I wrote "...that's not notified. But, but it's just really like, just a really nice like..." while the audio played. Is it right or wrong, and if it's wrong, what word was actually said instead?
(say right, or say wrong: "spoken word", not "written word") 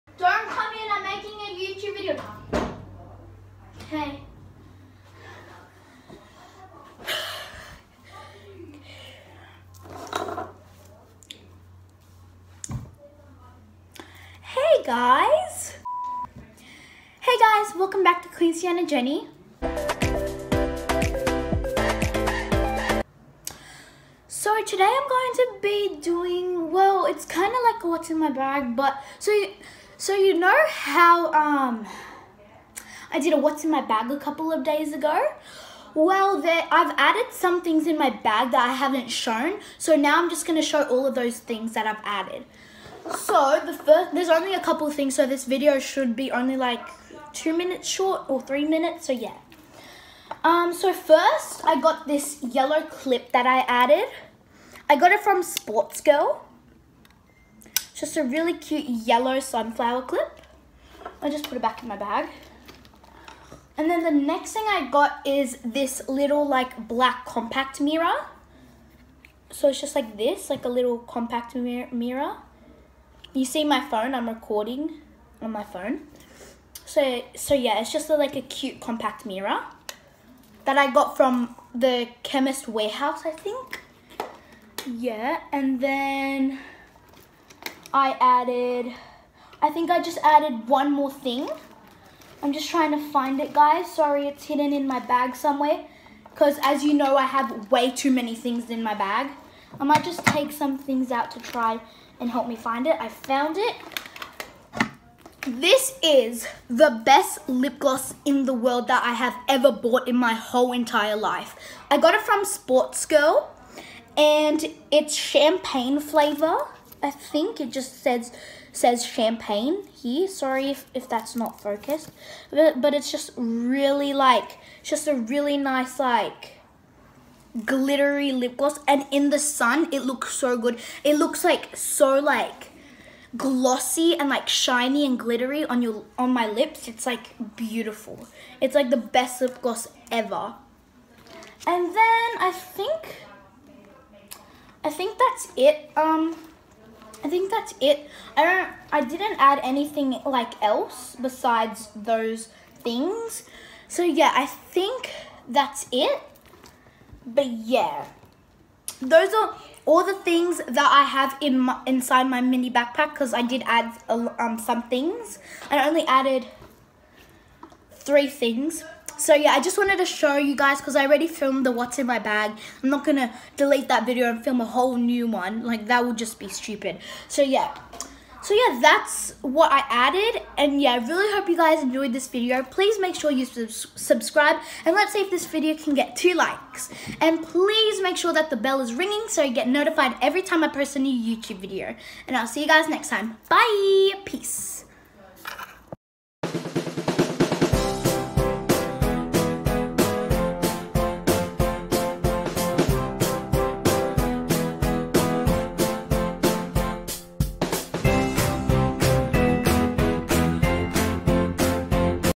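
wrong: "focused", not "notified".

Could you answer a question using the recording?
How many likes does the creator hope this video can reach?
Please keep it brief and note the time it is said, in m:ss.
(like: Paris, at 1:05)
2, at 3:06.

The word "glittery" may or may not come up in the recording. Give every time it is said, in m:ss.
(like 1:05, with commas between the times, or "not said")
2:07, 2:15.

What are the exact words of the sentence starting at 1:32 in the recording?
I'm just trying to find it, guys.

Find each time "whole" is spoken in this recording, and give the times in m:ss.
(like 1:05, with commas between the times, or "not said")
1:50, 2:54.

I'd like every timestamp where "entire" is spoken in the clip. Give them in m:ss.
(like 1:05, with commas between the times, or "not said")
1:50.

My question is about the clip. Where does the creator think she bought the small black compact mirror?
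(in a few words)
Chemist Warehouse.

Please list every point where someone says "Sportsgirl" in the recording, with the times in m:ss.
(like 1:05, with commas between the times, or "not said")
0:55, 1:52.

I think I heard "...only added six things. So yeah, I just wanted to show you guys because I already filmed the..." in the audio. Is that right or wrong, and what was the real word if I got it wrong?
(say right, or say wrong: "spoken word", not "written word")
wrong: "three", not "six".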